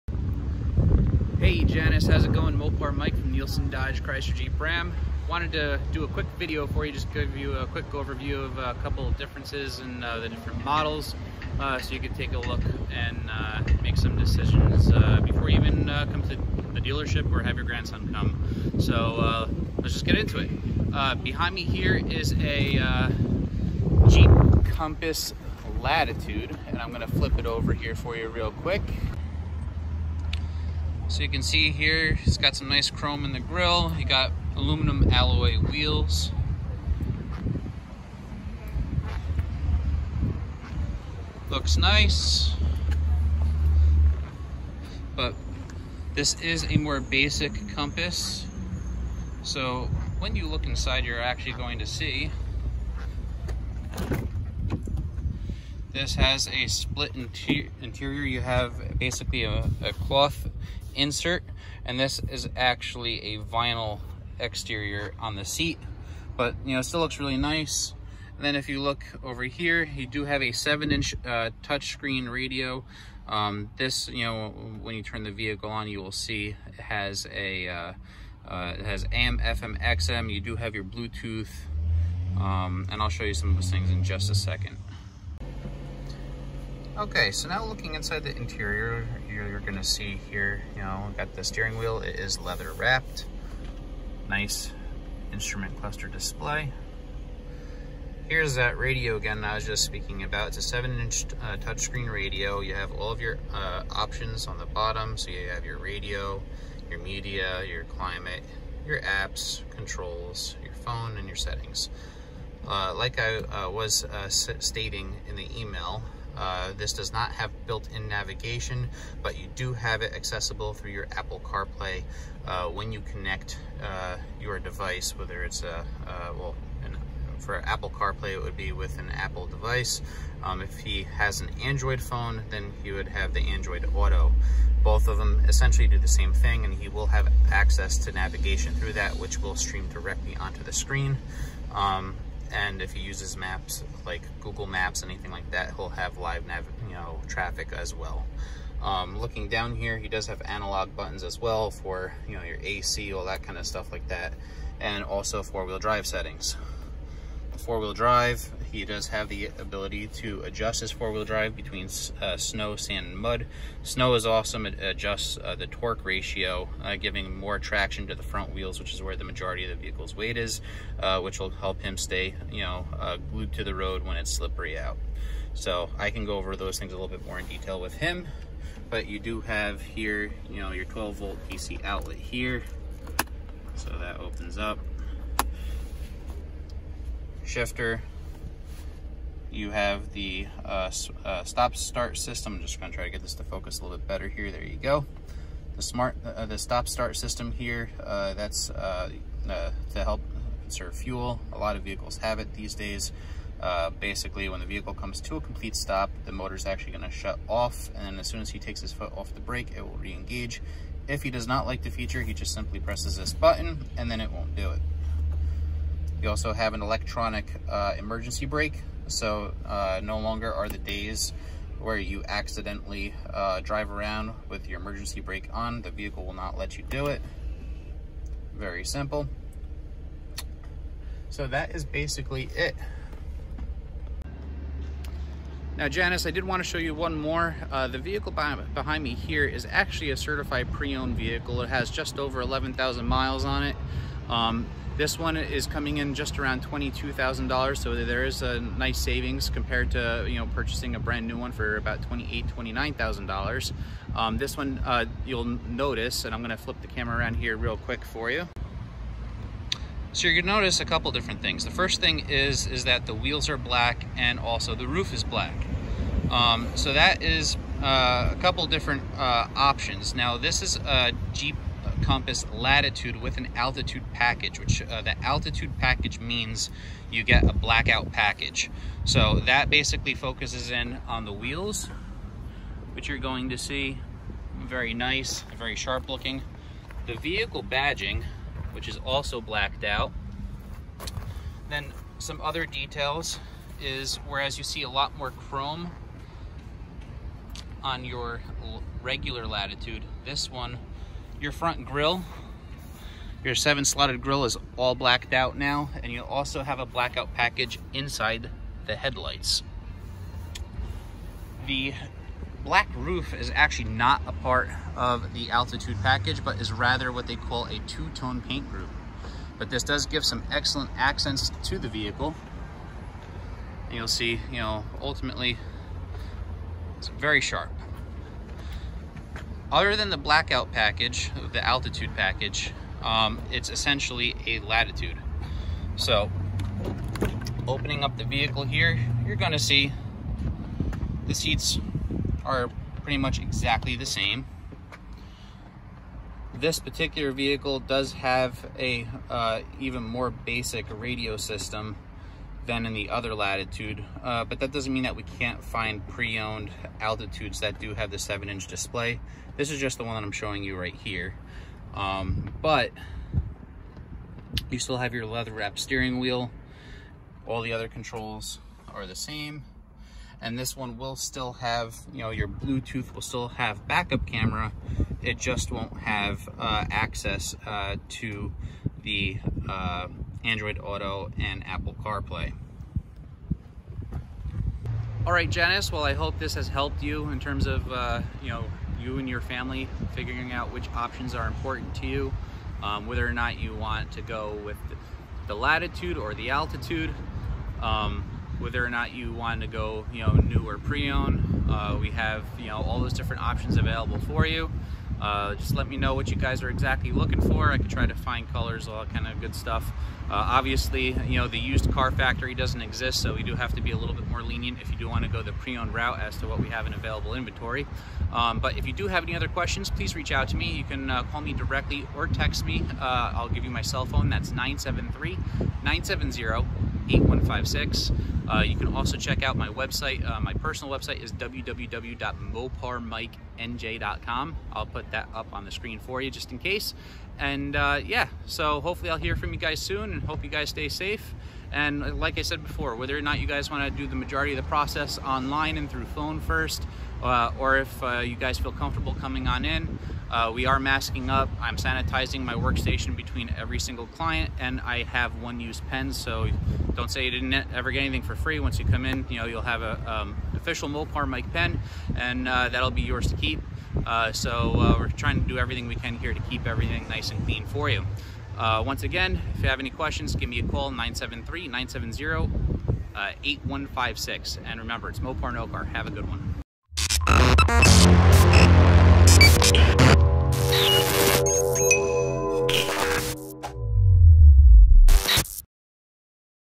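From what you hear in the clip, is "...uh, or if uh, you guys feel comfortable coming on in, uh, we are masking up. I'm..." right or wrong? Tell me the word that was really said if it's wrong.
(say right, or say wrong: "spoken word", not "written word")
right.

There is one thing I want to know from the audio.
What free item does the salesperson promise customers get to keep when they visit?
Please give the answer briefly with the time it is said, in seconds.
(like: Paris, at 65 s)
Mopar Mike pen, at 460 s.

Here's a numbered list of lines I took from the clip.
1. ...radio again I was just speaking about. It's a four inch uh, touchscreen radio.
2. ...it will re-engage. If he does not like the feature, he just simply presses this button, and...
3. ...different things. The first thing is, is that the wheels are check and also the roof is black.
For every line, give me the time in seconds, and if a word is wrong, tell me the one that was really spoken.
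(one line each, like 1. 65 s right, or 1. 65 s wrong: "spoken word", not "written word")
1. 98 s wrong: "seven", not "four"
2. 209 s right
3. 261 s wrong: "black", not "check".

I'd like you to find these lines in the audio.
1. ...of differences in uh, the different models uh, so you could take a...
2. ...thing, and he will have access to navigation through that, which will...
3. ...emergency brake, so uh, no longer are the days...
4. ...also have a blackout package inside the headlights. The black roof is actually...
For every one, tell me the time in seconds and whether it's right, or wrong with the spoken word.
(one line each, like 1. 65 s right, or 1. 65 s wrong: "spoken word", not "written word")
1. 9 s right
2. 136 s right
3. 217 s right
4. 306 s right.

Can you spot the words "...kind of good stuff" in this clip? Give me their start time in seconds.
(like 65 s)
409 s.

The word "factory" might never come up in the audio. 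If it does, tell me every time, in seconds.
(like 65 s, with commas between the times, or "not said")
412 s.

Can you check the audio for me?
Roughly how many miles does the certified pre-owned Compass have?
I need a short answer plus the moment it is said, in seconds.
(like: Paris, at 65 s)
Just over 11,000, at 241 s.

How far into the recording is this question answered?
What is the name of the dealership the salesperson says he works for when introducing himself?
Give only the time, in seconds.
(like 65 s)
3 s.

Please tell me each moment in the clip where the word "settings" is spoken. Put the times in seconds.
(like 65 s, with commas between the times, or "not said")
111 s, 156 s.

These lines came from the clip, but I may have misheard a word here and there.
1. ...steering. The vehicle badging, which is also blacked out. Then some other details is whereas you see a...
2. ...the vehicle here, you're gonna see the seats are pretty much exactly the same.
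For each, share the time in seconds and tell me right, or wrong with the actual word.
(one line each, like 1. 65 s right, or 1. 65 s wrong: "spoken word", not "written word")
1. 286 s wrong: "looking", not "steering"
2. 338 s right.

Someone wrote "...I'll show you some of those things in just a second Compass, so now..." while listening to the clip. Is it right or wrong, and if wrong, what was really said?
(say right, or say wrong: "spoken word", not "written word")
wrong: "Okay", not "Compass".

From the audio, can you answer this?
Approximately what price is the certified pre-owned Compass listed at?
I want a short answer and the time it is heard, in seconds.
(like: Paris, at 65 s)
$22,000, at 246 s.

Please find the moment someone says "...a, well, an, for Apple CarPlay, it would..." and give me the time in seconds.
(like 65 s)
125 s.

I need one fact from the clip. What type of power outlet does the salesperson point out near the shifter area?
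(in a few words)
12 volt DC.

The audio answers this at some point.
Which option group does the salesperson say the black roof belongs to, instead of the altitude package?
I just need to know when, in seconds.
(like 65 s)
317 s.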